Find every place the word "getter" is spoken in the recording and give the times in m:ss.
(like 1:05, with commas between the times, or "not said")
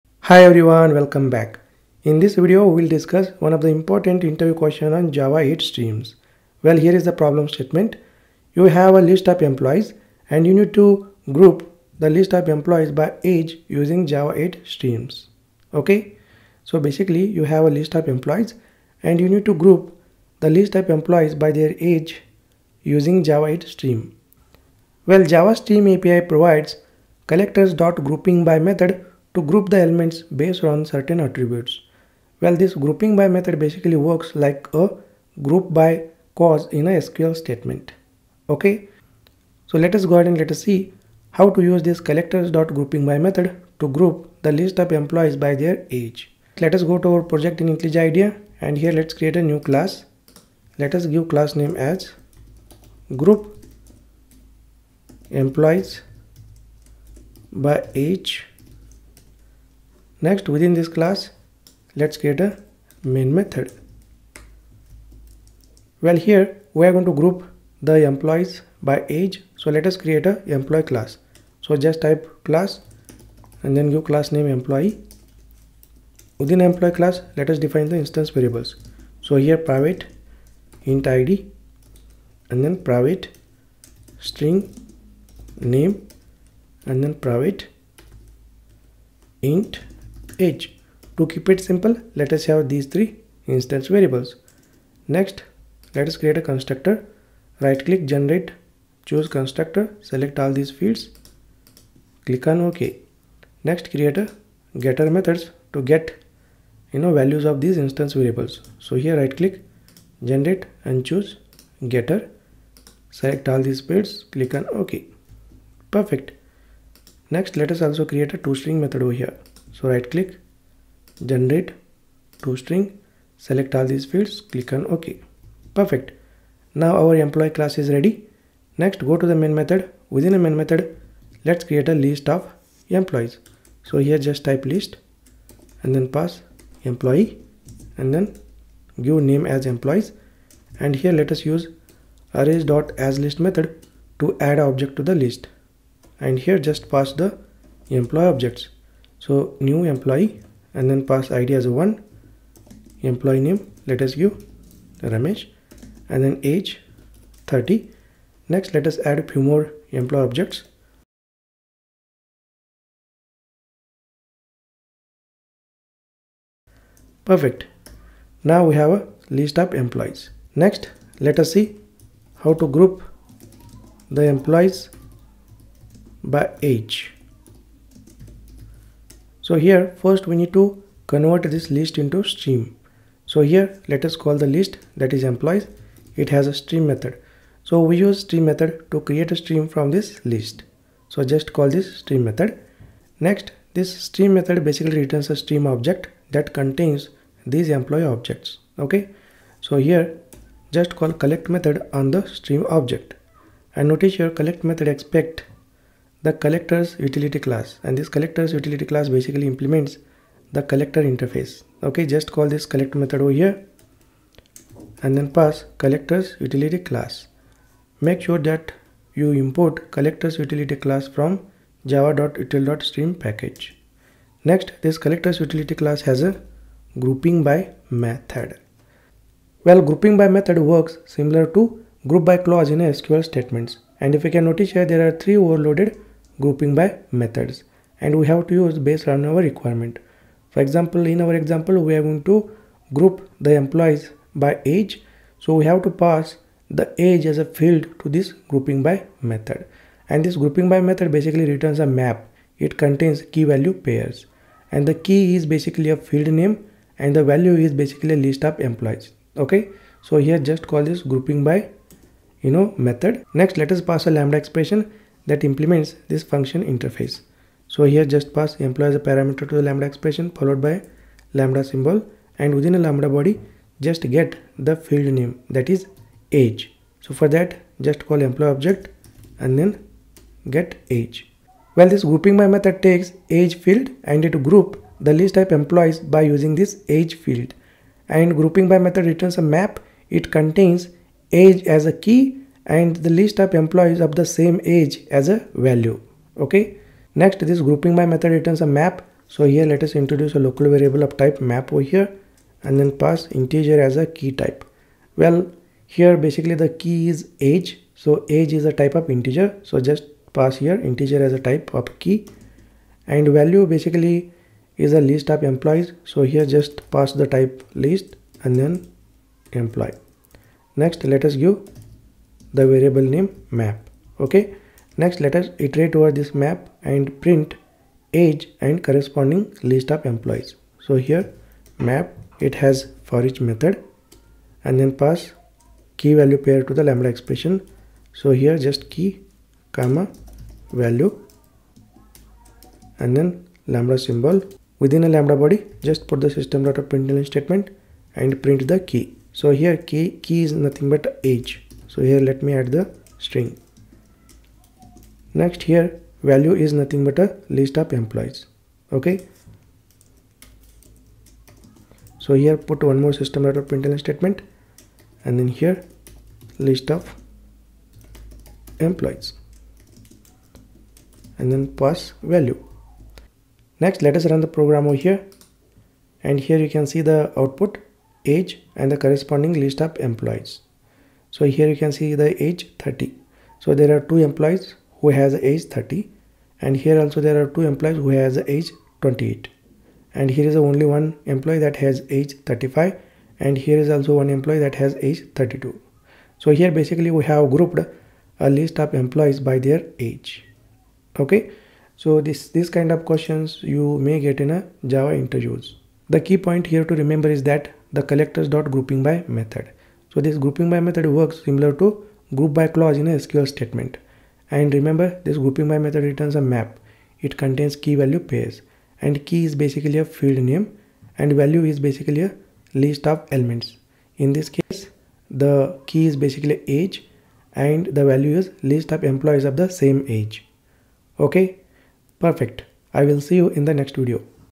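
1:44, 1:51.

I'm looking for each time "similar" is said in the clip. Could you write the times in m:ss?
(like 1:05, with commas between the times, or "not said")
3:51, 6:51.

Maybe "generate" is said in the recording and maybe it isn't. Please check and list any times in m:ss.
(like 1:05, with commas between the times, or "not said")
1:38, 1:50, 2:01.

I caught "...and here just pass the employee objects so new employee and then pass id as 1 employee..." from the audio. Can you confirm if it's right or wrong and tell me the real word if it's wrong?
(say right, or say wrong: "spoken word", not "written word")
right.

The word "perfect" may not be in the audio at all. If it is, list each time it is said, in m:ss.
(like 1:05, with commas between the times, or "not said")
1:55, 2:05, 2:47, 7:12.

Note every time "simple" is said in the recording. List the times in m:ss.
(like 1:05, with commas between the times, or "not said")
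1:31.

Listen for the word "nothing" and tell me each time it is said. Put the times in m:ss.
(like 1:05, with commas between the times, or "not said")
5:50, 5:56.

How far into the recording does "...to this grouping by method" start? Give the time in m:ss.
4:07.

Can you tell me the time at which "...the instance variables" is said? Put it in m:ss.
1:17.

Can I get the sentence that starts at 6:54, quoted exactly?
And remember this grouping by method returns a map.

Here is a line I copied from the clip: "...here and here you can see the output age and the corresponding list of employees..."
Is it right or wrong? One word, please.
right.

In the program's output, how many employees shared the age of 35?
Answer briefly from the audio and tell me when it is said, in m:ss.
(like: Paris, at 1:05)
1, at 6:30.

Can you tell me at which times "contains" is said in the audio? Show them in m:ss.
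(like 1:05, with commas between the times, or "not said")
3:16, 4:12, 4:50, 6:57.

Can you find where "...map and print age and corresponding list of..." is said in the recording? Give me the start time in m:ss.
5:26.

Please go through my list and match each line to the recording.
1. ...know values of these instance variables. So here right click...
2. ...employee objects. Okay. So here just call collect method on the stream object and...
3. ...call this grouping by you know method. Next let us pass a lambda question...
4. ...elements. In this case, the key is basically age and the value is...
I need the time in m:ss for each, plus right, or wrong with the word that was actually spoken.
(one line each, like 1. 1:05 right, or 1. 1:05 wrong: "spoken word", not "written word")
1. 1:47 right
2. 3:17 right
3. 4:20 wrong: "expression", not "question"
4. 7:03 right.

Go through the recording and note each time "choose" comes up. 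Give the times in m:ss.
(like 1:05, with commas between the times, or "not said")
1:39, 1:51.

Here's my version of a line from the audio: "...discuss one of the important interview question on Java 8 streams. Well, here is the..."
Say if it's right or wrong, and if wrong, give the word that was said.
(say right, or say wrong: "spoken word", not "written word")
right.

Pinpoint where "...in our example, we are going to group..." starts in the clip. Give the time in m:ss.
4:01.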